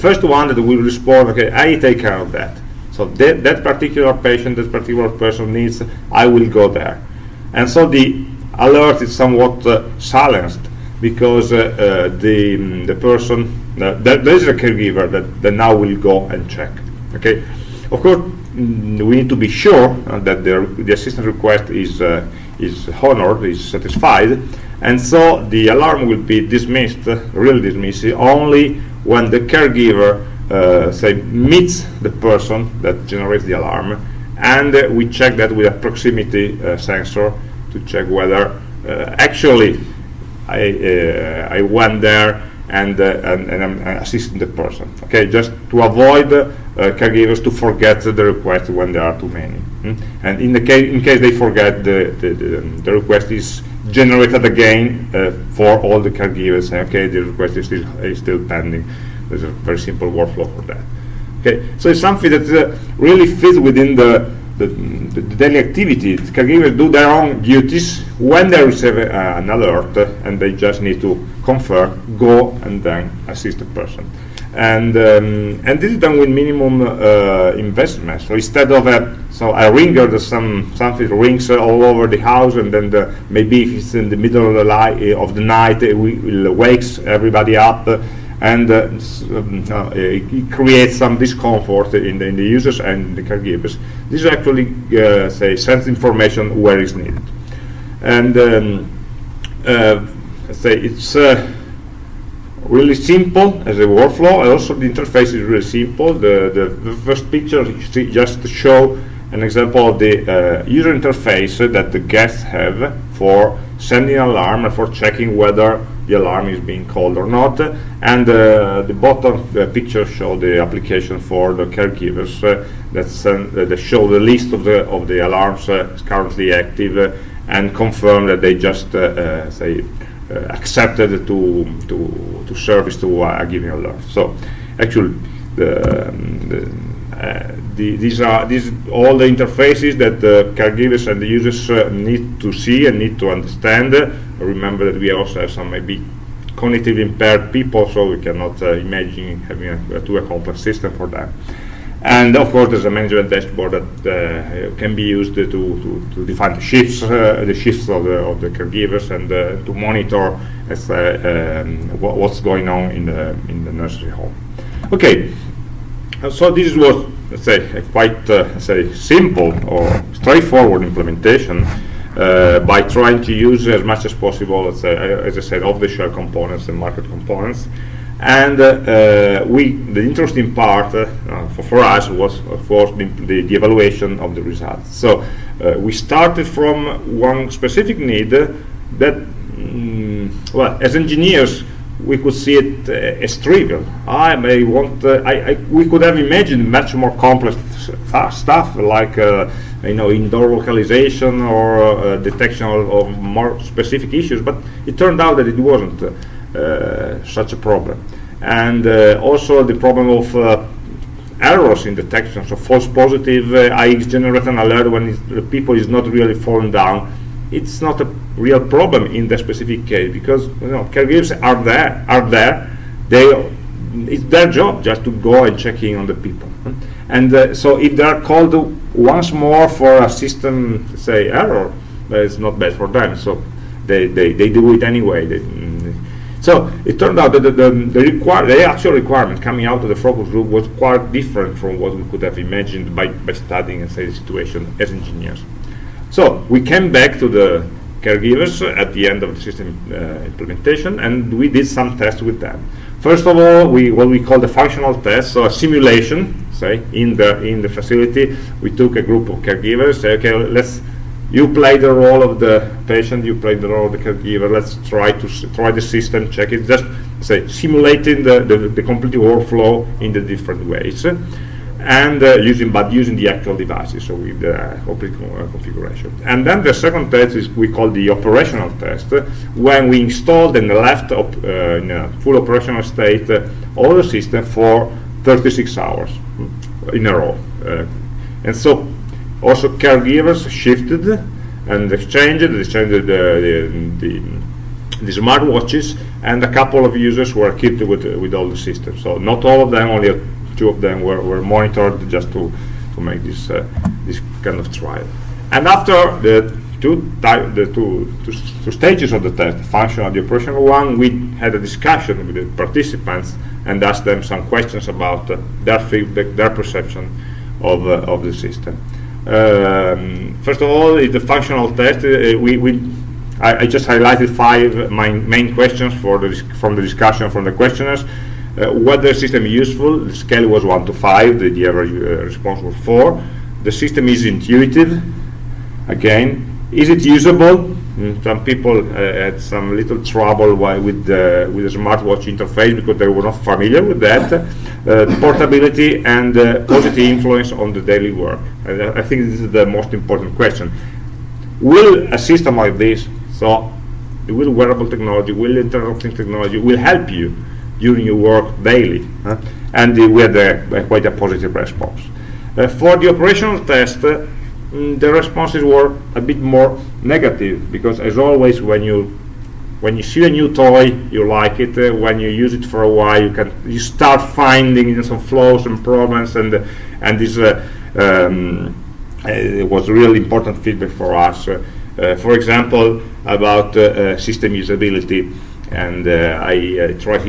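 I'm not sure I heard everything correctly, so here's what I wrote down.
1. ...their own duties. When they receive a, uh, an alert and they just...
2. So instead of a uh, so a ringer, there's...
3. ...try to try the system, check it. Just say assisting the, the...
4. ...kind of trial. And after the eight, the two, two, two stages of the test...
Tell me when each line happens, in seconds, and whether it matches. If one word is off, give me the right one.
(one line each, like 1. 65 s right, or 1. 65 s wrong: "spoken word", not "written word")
1. 66 s right
2. 78 s right
3. 264 s wrong: "simulating", not "assisting"
4. 304 s wrong: "two", not "eight".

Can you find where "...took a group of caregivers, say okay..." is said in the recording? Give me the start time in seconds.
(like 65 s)
258 s.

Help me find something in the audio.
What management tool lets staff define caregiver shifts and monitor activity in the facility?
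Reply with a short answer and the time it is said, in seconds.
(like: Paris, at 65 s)
management dashboard, at 152 s.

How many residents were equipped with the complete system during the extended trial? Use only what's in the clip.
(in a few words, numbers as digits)
2.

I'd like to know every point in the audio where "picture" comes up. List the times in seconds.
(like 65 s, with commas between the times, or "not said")
107 s, 119 s.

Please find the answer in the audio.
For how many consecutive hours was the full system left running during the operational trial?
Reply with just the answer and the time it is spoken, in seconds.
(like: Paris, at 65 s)
36, at 285 s.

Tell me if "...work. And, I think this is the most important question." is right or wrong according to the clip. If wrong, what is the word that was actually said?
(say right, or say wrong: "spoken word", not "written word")
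right.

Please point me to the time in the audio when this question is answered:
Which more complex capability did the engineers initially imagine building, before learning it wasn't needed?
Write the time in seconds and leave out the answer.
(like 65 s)
200 s.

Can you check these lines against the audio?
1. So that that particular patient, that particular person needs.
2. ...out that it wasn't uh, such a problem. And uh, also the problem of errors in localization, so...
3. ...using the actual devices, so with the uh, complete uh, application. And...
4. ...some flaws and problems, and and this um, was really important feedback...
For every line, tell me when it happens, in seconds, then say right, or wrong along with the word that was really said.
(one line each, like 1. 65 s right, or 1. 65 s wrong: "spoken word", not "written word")
1. 2 s right
2. 205 s wrong: "detection", not "localization"
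3. 272 s wrong: "configuration", not "application"
4. 375 s right.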